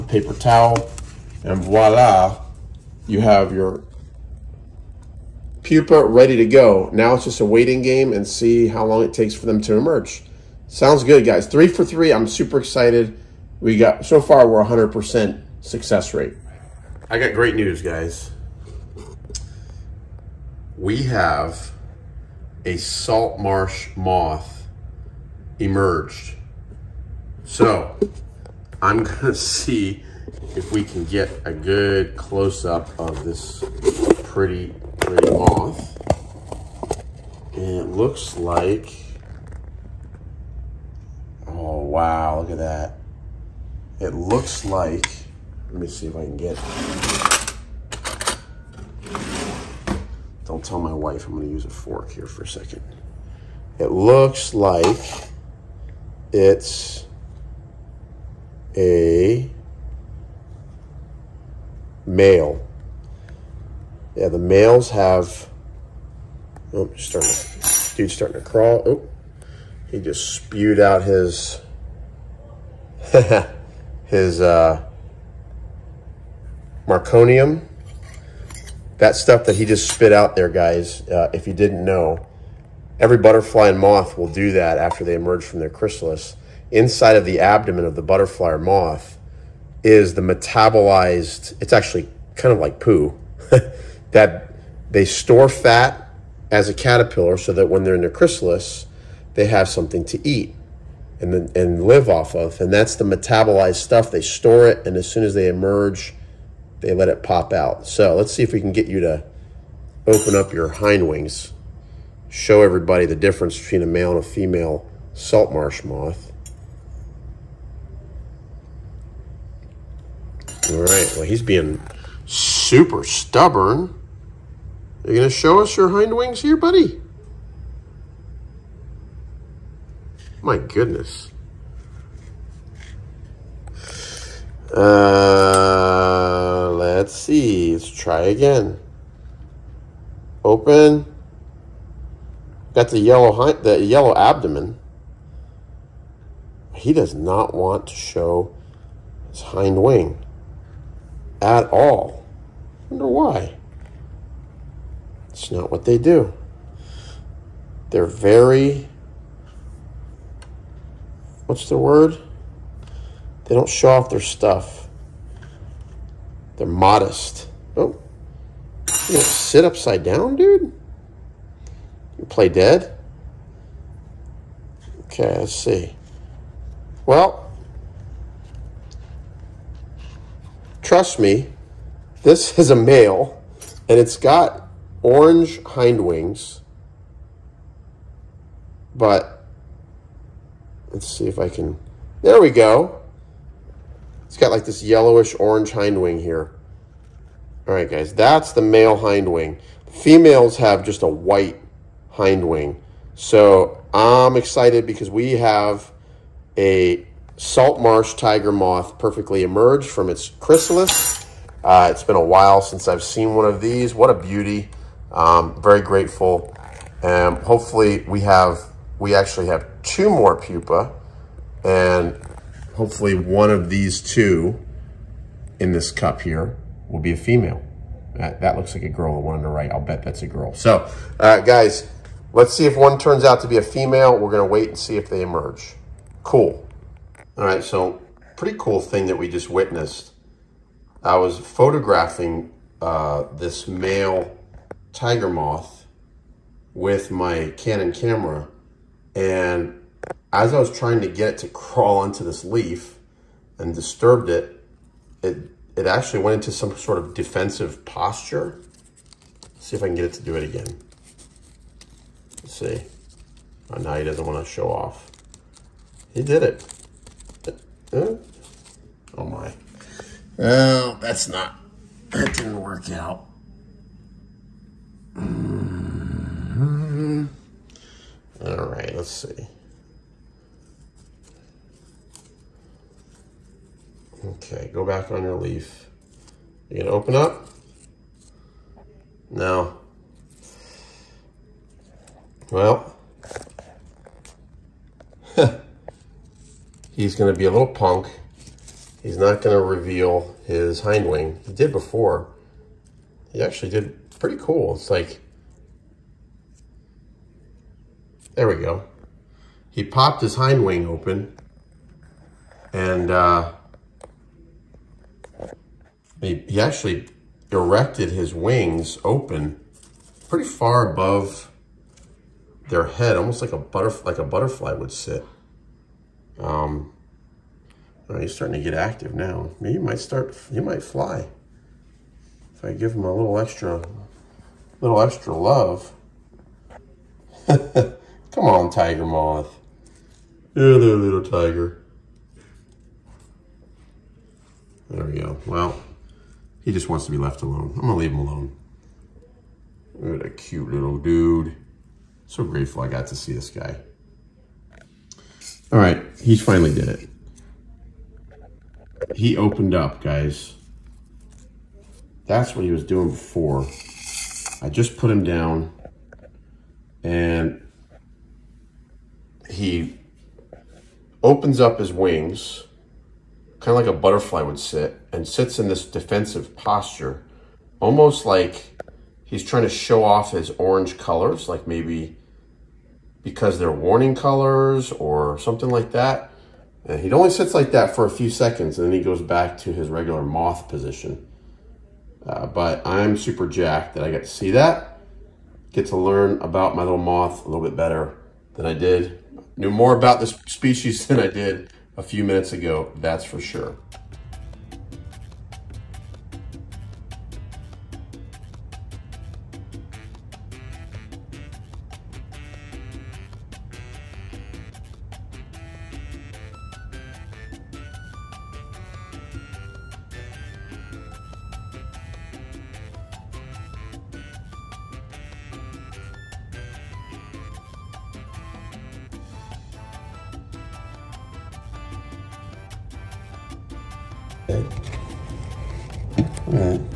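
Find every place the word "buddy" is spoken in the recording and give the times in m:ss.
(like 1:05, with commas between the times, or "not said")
2:06.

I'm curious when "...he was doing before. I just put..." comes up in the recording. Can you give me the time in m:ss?
6:02.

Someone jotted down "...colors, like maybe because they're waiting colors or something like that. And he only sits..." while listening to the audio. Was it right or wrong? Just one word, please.
wrong.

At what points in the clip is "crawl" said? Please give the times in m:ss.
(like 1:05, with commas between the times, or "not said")
1:08, 4:11.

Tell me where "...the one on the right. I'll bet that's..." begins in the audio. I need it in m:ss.
3:49.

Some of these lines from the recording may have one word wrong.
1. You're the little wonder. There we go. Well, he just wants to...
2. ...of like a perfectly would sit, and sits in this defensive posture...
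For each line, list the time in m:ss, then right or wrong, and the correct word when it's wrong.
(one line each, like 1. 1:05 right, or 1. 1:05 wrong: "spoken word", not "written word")
1. 5:40 wrong: "tiger", not "wonder"
2. 6:13 wrong: "butterfly", not "perfectly".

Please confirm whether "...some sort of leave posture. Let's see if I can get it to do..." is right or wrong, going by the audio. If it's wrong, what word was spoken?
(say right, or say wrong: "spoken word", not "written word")
wrong: "defensive", not "leave".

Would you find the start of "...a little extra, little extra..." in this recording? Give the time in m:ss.
5:33.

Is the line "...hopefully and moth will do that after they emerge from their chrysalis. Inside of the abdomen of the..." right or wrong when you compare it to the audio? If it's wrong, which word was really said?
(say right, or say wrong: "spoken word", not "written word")
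wrong: "butterfly", not "hopefully".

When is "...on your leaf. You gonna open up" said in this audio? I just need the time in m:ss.
4:45.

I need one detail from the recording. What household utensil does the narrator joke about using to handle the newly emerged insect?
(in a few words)
fork.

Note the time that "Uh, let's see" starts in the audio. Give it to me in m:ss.
2:14.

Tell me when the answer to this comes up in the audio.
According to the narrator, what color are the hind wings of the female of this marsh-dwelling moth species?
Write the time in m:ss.
3:21.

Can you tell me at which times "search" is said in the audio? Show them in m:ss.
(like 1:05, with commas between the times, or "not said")
not said.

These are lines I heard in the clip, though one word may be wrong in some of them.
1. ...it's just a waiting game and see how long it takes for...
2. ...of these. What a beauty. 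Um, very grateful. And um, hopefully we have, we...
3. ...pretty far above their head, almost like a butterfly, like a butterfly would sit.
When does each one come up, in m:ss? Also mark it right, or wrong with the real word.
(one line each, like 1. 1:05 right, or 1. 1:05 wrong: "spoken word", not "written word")
1. 0:07 right
2. 3:33 right
3. 5:20 right.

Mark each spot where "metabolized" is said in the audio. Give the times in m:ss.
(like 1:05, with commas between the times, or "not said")
1:30, 1:43.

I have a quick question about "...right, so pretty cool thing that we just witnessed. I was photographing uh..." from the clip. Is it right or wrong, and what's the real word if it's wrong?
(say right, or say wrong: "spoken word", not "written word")
right.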